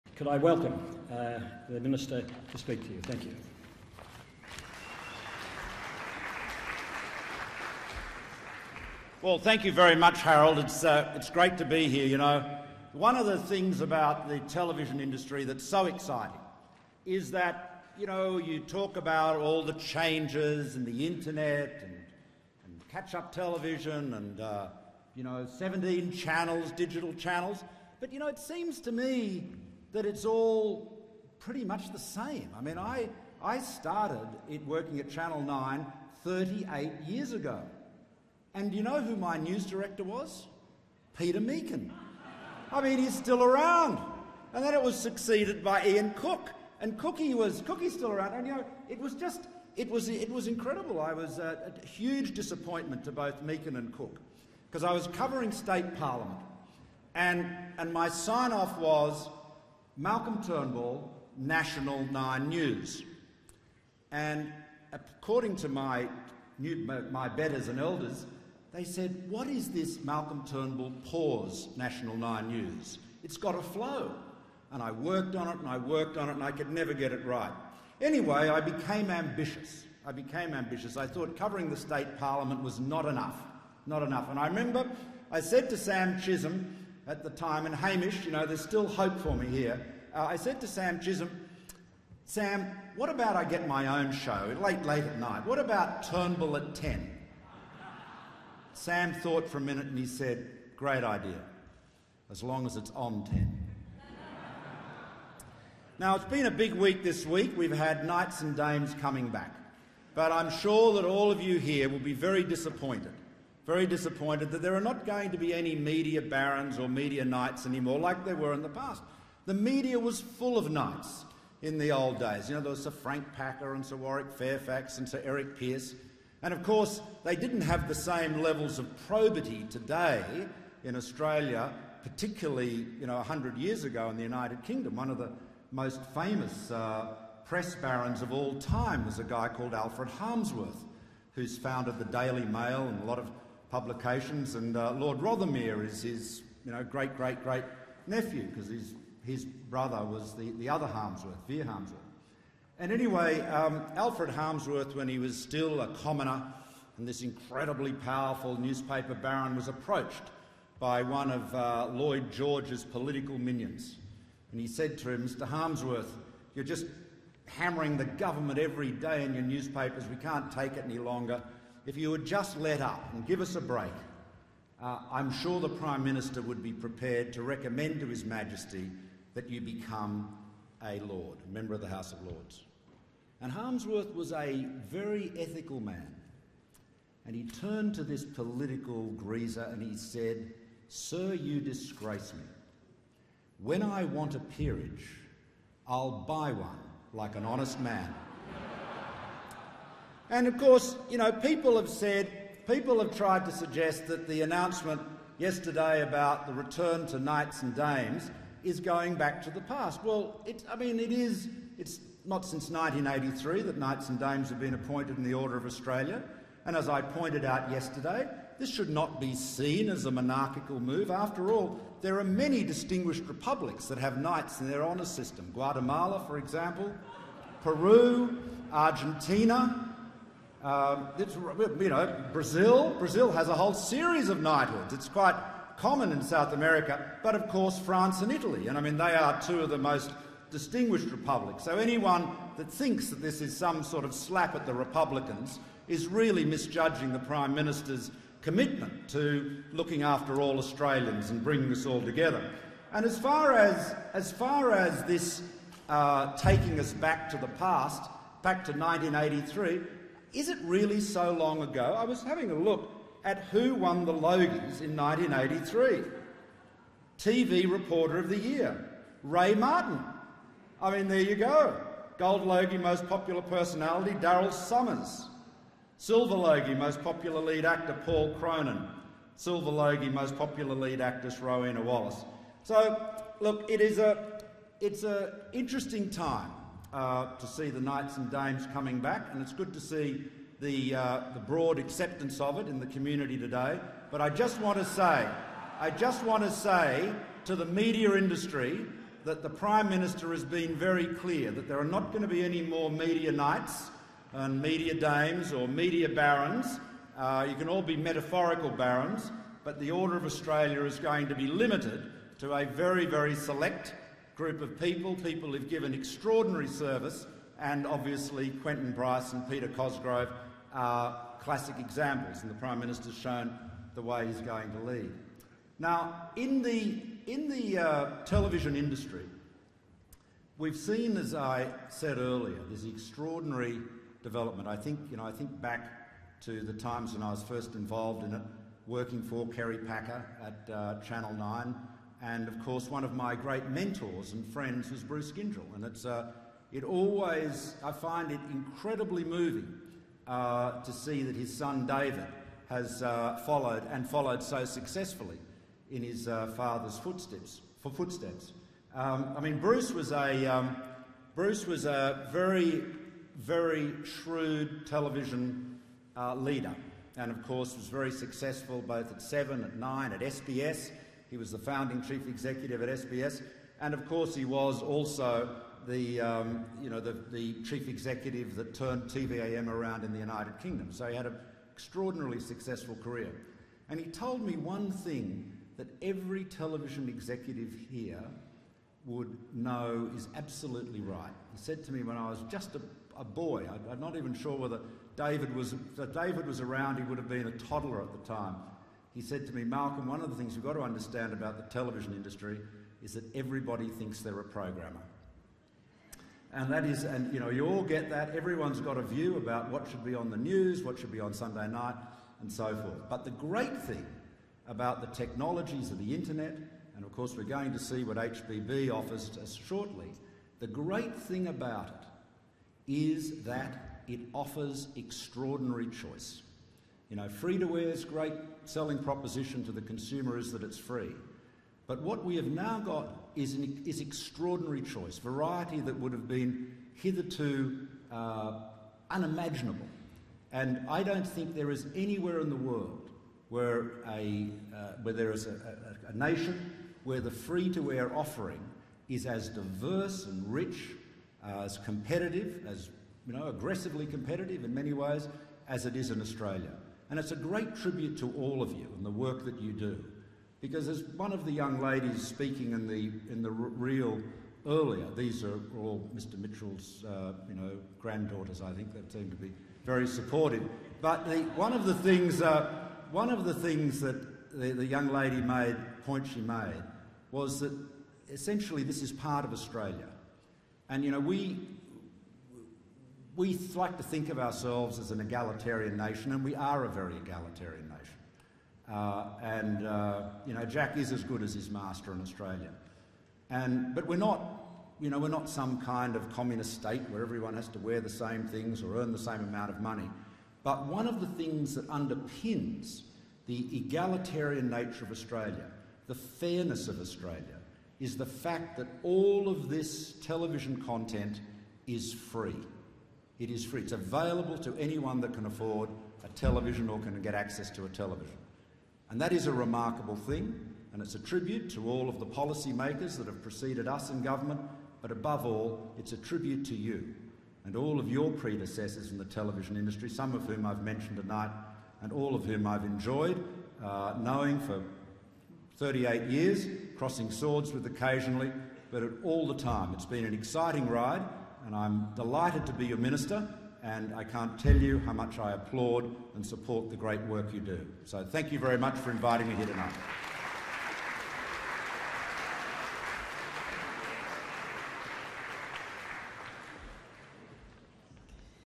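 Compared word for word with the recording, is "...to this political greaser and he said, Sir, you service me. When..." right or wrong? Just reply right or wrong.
wrong.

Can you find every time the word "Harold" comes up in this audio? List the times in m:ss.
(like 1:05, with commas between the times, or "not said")
0:10.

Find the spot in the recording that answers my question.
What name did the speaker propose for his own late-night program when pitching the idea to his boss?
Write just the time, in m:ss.
1:36.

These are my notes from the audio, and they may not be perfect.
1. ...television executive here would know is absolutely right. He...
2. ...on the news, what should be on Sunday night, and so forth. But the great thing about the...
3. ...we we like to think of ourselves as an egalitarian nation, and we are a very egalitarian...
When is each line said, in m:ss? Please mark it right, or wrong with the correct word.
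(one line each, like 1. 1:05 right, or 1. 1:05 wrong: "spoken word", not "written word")
1. 6:26 right
2. 6:50 right
3. 8:01 right.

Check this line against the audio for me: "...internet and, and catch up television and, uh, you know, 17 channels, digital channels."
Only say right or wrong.
right.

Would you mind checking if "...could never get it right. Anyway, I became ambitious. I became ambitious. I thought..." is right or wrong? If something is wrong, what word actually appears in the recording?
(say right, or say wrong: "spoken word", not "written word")
right.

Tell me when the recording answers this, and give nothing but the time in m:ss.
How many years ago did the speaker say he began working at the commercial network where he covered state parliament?
0:36.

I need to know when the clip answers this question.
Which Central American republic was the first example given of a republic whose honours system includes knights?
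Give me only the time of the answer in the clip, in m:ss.
3:45.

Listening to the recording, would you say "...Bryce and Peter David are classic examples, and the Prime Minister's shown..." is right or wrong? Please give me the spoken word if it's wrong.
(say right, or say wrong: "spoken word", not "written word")
wrong: "Cosgrove", not "David".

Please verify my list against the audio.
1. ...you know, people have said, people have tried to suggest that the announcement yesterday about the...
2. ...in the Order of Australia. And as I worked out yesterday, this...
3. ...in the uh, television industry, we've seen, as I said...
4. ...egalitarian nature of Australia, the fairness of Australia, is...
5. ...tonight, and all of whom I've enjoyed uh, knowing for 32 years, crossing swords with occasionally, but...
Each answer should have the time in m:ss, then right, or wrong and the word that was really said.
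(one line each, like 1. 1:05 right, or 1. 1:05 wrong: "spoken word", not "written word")
1. 3:21 right
2. 3:35 wrong: "pointed", not "worked"
3. 5:27 right
4. 8:23 right
5. 8:51 wrong: "38", not "32".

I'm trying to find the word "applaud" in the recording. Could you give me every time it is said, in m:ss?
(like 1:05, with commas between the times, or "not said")
9:05.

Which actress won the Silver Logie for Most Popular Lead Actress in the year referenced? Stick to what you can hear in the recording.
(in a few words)
Rowena Wallace.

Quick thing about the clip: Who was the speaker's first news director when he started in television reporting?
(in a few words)
Peter Meakin.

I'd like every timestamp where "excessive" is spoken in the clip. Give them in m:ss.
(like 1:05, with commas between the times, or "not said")
not said.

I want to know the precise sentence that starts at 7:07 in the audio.
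You know, free-to-air's great selling proposition to the consumer is that it's free.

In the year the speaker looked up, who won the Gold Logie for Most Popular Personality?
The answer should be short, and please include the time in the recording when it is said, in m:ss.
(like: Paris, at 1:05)
Daryl Somers, at 4:34.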